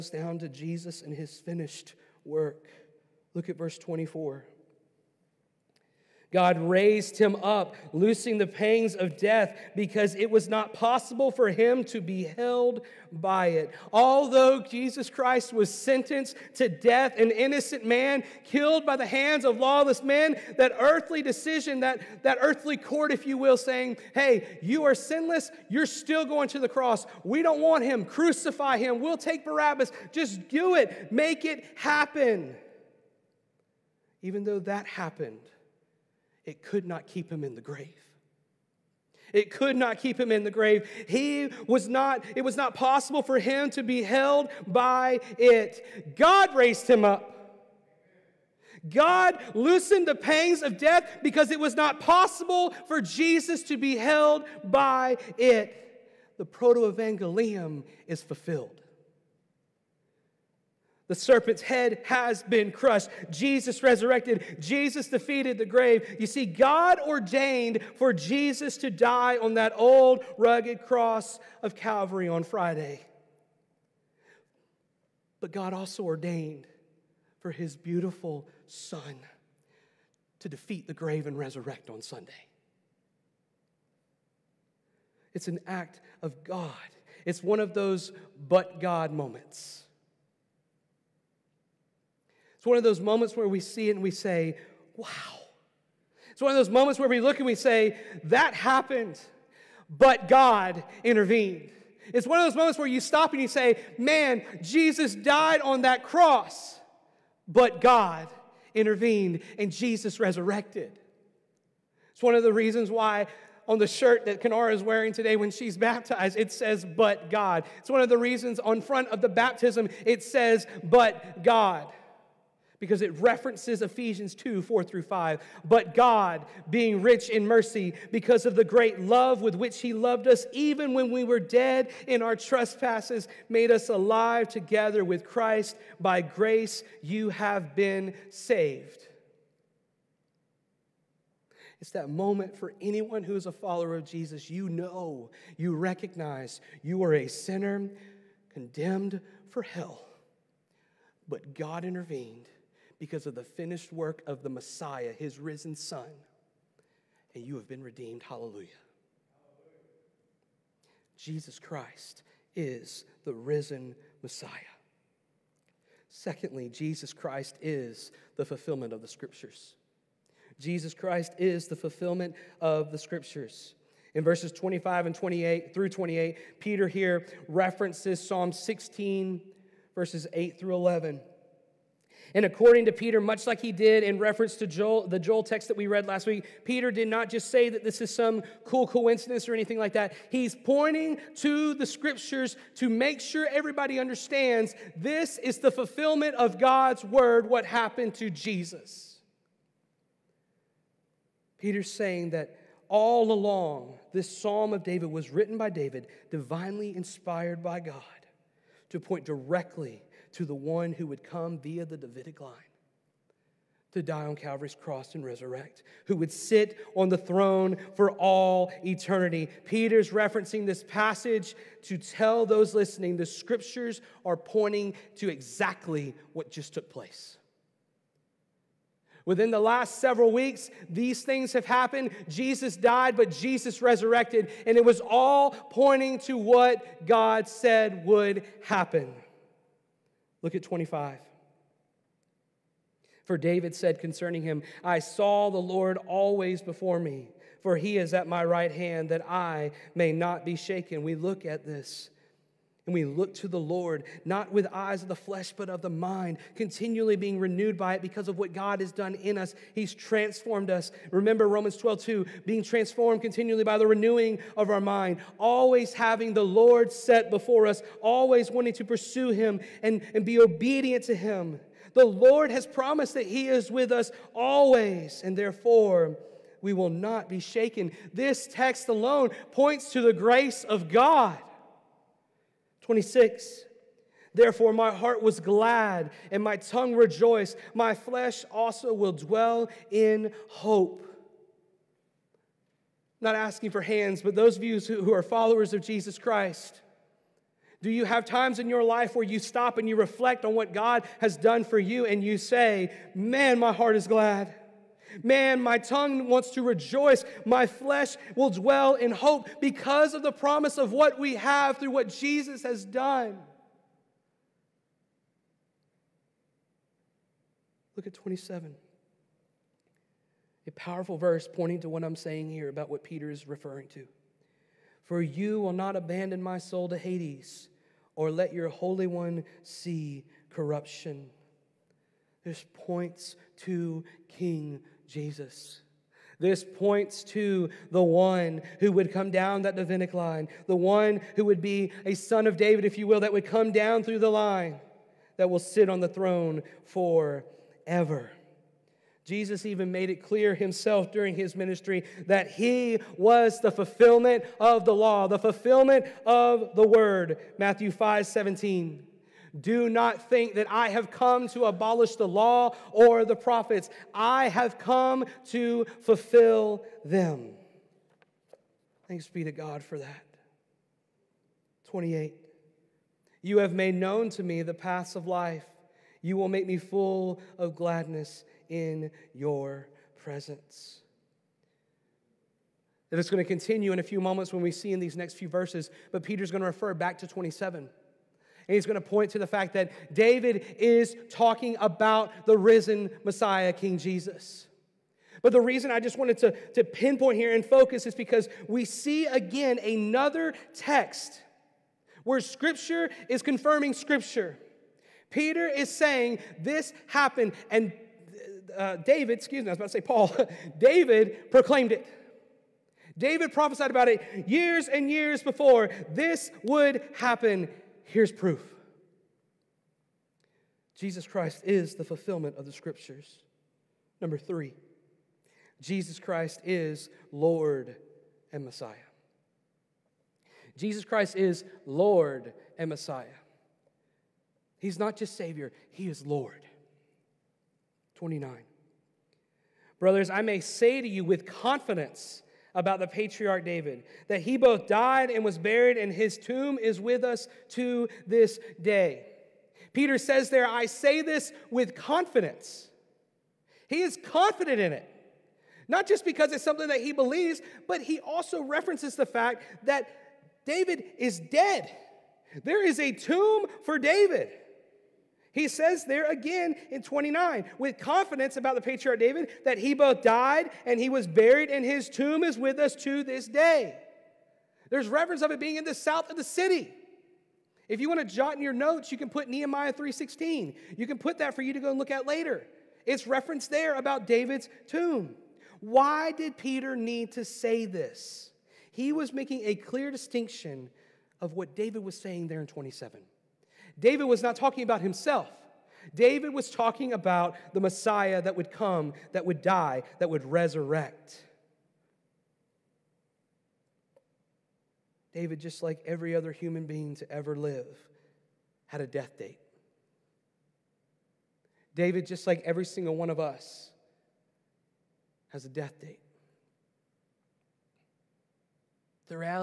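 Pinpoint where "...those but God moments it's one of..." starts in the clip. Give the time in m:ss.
1:27.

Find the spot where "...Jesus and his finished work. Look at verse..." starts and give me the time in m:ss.
0:00.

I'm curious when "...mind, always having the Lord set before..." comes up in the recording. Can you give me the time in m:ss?
4:24.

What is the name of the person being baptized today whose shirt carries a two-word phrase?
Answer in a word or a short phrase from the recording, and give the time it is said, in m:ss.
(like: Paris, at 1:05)
Kenara, at 1:54.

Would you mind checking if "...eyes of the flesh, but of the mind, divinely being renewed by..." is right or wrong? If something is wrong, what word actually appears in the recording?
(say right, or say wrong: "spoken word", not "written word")
wrong: "continually", not "divinely".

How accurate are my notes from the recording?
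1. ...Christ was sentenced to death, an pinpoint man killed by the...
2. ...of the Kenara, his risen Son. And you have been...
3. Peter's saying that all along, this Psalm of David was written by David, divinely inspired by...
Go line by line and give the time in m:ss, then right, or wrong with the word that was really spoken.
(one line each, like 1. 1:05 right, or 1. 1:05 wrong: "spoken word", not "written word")
1. 0:15 wrong: "innocent", not "pinpoint"
2. 2:34 wrong: "Messiah", not "Kenara"
3. 3:21 right.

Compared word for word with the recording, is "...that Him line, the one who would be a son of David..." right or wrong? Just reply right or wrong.
wrong.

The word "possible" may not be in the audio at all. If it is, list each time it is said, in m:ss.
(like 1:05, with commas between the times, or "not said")
0:10, 0:42, 0:52.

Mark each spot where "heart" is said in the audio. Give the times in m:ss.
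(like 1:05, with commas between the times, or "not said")
4:44, 5:03.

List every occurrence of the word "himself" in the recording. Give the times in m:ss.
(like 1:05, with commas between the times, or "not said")
5:50, 8:15.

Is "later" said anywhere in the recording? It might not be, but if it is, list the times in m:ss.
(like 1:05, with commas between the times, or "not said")
8:02.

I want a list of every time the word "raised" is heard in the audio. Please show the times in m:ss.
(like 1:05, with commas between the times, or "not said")
0:06, 0:46.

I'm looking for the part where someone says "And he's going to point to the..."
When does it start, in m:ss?
6:28.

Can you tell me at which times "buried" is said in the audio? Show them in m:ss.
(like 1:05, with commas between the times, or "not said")
7:25, 7:51.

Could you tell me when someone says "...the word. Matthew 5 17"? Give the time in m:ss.
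5:56.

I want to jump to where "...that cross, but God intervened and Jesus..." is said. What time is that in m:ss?
1:45.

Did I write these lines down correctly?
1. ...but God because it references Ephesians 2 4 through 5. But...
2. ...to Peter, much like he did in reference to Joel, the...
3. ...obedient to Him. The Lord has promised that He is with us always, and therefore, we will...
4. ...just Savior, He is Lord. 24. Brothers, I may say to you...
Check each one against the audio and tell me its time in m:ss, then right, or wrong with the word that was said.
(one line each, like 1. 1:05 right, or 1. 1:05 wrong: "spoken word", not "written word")
1. 2:00 right
2. 3:02 right
3. 4:30 right
4. 7:15 wrong: "29", not "24".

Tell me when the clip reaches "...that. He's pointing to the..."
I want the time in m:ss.
3:09.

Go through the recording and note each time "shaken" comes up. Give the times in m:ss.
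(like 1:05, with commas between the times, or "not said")
4:10, 4:37.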